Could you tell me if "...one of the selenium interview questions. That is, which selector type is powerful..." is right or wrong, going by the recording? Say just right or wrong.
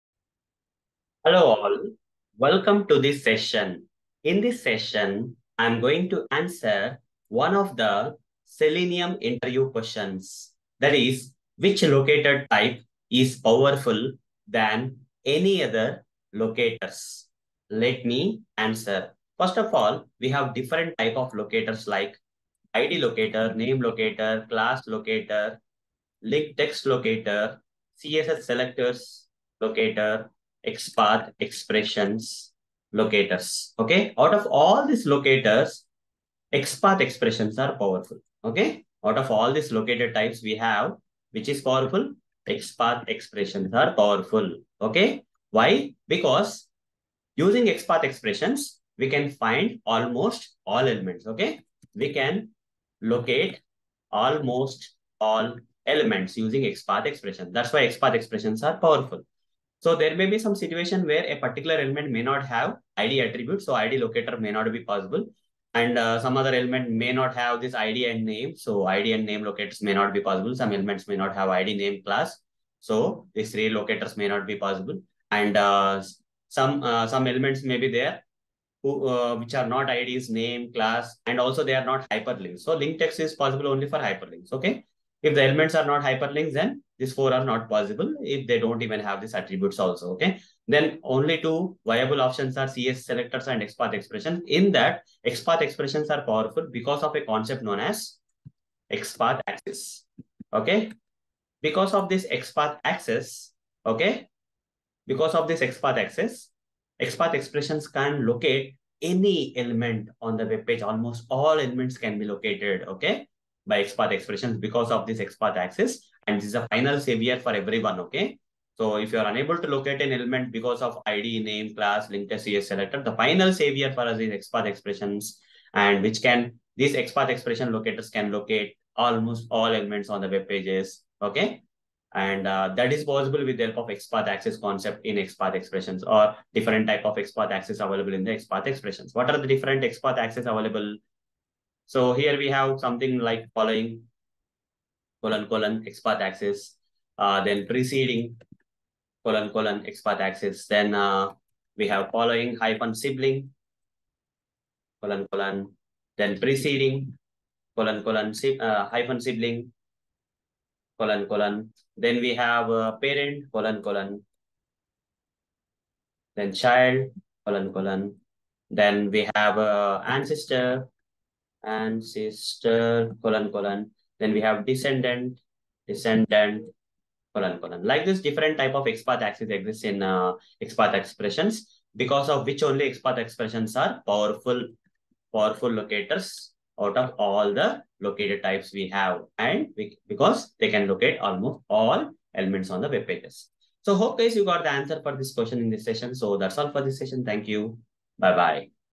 wrong.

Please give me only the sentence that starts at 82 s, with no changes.
So link text is possible only for hyperlinks.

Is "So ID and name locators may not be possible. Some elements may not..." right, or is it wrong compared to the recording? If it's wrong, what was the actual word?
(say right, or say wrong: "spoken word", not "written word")
right.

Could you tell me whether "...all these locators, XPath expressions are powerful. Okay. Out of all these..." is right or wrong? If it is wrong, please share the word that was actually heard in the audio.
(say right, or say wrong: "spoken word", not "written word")
right.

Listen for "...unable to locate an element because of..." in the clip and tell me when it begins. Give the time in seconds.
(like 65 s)
119 s.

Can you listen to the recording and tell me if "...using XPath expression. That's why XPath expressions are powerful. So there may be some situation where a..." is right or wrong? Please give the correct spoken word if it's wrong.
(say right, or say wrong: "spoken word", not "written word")
right.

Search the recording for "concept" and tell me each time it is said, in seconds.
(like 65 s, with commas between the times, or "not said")
97 s, 134 s.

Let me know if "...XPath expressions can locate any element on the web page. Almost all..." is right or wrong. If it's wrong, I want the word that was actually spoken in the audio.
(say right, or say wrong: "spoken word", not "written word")
right.